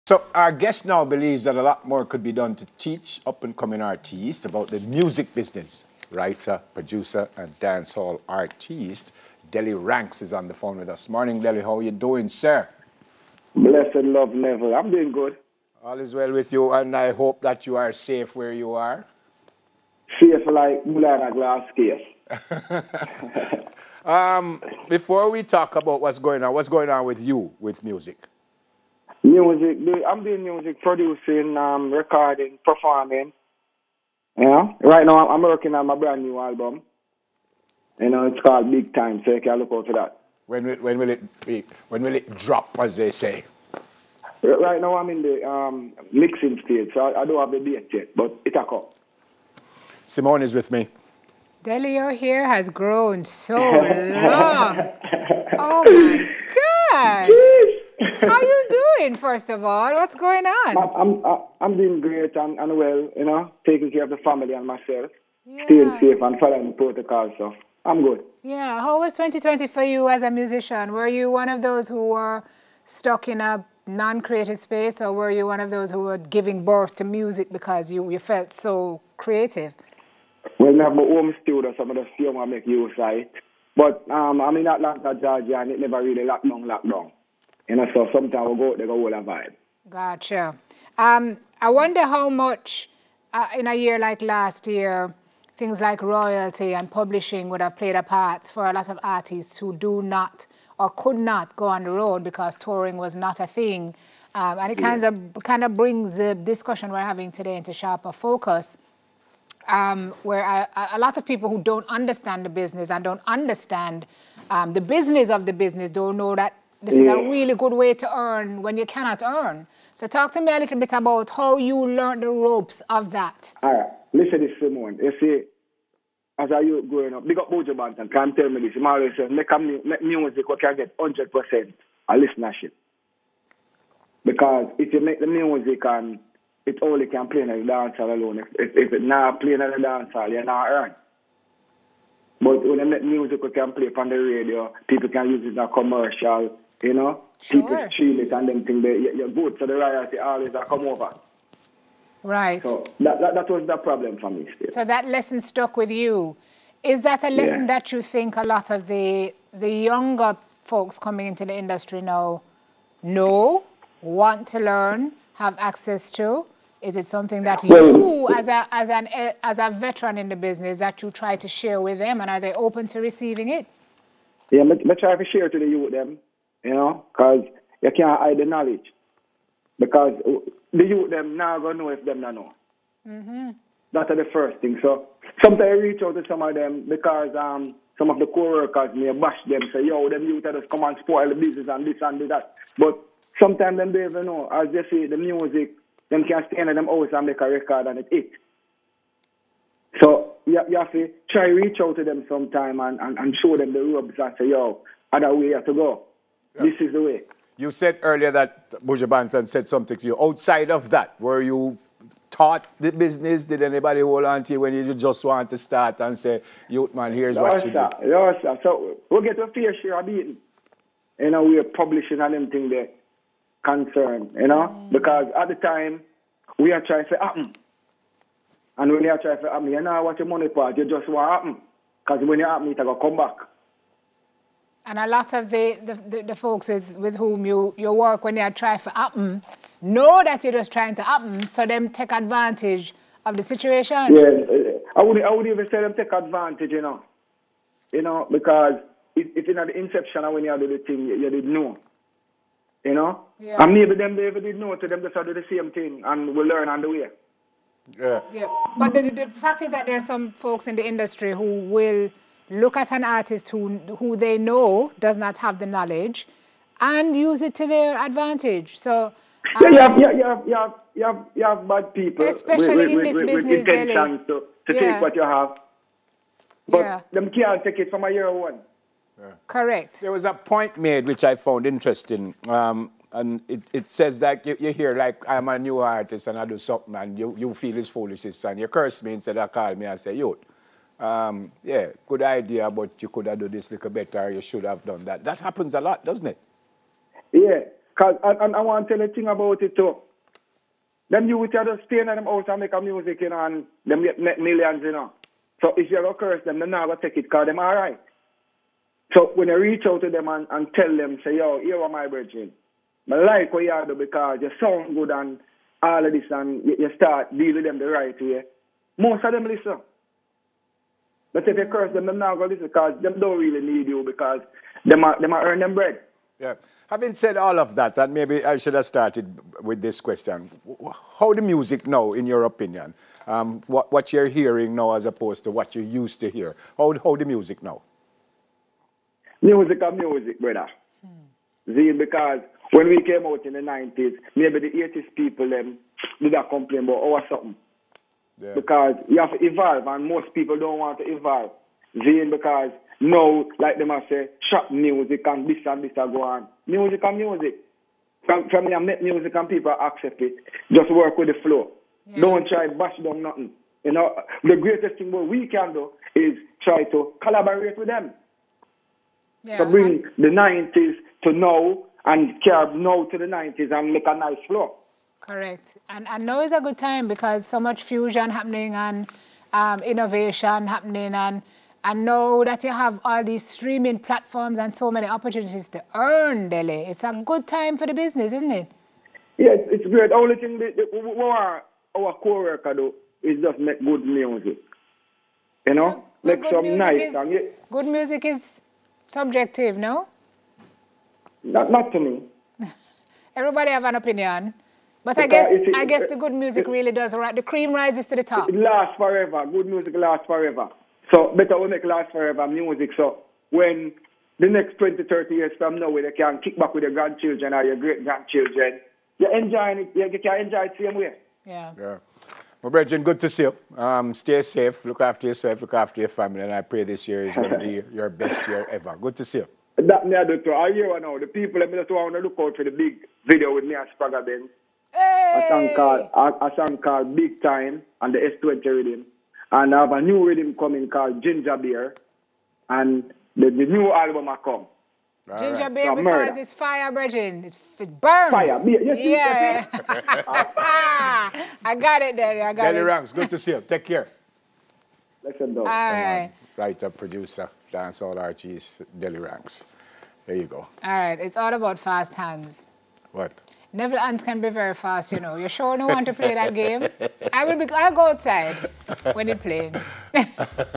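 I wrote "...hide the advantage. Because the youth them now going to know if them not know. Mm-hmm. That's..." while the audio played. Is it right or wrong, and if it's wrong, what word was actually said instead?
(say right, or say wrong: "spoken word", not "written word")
wrong: "knowledge", not "advantage".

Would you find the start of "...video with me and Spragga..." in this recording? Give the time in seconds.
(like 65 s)
433 s.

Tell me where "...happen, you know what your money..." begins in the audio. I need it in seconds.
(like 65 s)
229 s.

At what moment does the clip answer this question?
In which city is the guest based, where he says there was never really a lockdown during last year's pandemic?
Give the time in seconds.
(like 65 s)
84 s.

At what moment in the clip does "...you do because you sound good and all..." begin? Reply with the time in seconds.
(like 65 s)
313 s.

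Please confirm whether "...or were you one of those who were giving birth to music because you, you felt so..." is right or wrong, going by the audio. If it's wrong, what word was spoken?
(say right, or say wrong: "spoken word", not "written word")
right.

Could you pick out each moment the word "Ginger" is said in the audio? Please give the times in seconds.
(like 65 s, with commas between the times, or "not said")
441 s, 445 s.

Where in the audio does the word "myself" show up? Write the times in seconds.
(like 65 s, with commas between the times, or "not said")
64 s.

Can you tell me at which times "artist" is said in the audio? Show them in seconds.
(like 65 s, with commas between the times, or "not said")
3 s, 8 s, 99 s, 263 s, 285 s, 458 s.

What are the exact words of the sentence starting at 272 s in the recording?
Especially with, in this with, business.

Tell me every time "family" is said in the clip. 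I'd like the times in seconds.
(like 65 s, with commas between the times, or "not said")
64 s, 426 s.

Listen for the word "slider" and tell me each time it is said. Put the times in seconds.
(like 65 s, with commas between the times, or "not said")
not said.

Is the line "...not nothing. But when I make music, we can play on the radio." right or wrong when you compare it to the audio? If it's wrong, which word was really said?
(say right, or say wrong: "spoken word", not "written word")
wrong: "earning", not "nothing".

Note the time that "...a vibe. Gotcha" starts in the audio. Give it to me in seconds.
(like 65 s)
89 s.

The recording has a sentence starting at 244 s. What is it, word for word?
Yeah, uh, I would I would even say them take advantage, you know.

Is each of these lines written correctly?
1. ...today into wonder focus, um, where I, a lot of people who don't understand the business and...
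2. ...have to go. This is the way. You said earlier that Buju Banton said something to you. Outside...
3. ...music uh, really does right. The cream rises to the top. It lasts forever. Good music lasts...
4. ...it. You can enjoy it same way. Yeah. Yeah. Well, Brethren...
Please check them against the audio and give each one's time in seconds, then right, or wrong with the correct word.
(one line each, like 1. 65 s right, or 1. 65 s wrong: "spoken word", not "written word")
1. 107 s wrong: "sharper", not "wonder"
2. 205 s right
3. 406 s right
4. 419 s right.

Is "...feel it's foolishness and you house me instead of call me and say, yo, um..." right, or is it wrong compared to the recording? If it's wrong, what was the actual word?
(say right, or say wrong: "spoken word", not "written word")
wrong: "curse", not "house".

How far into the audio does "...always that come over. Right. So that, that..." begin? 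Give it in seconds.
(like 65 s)
150 s.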